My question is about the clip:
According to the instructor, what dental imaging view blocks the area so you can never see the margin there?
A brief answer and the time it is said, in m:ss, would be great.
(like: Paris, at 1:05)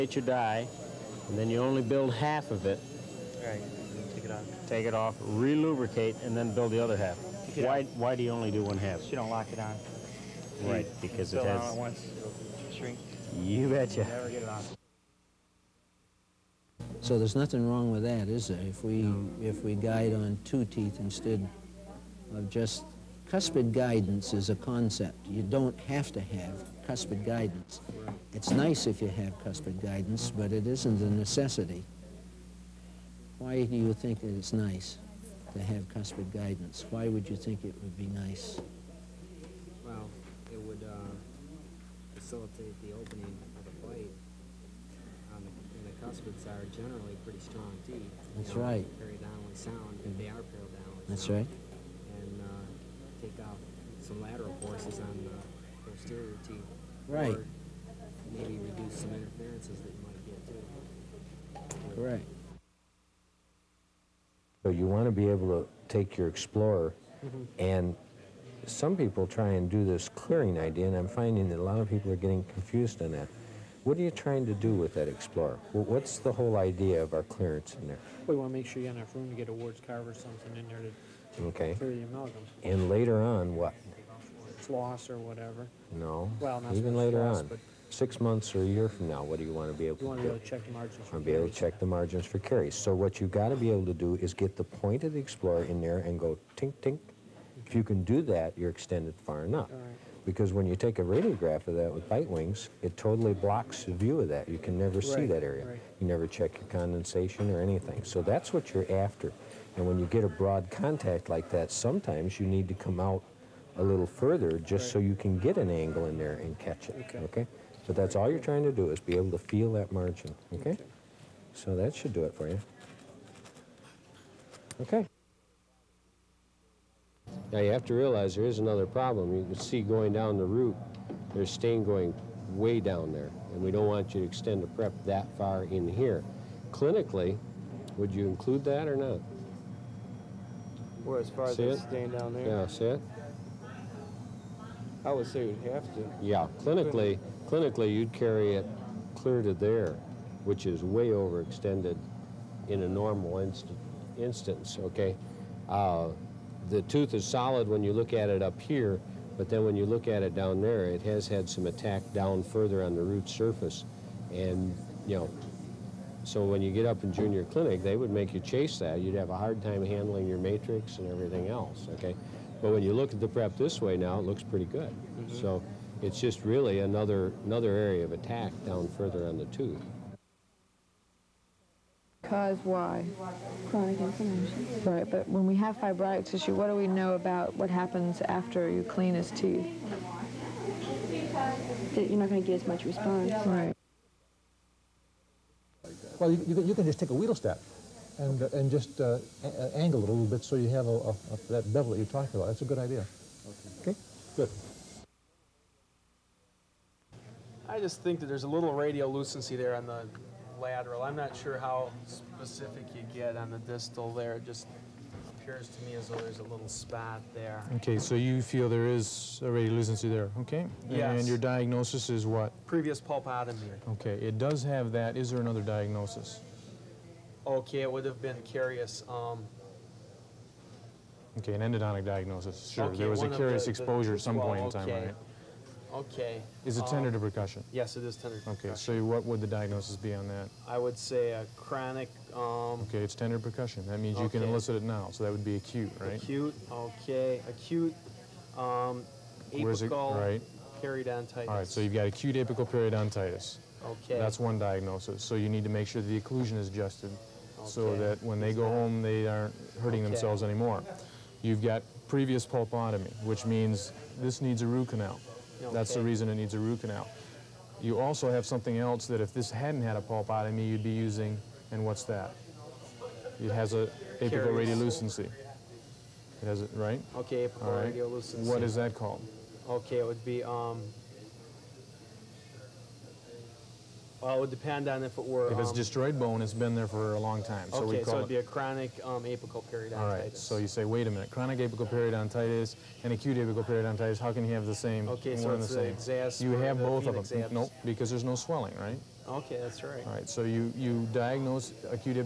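bite wings, at 1:42.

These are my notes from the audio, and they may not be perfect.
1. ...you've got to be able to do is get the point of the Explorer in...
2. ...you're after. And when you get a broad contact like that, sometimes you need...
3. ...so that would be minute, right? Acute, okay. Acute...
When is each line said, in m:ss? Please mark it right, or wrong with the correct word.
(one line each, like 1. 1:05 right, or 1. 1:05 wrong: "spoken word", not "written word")
1. 1:33 right
2. 1:48 right
3. 4:05 wrong: "acute", not "minute".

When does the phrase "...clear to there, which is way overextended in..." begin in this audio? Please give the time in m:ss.
2:29.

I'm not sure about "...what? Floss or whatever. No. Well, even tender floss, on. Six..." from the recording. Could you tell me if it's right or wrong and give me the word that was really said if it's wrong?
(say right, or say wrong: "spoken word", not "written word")
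wrong: "later", not "tender".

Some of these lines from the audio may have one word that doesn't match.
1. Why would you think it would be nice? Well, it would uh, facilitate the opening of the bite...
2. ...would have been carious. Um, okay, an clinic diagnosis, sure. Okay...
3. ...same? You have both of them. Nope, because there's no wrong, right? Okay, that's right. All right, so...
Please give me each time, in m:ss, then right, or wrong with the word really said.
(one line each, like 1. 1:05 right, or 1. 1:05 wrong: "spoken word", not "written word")
1. 0:36 right
2. 3:47 wrong: "endodontic", not "clinic"
3. 4:56 wrong: "swelling", not "wrong".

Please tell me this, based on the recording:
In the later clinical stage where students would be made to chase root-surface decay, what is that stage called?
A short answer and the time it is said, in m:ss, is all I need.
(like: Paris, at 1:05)
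junior clinic, at 2:47.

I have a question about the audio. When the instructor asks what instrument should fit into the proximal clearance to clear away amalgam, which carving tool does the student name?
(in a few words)
Ward's carver.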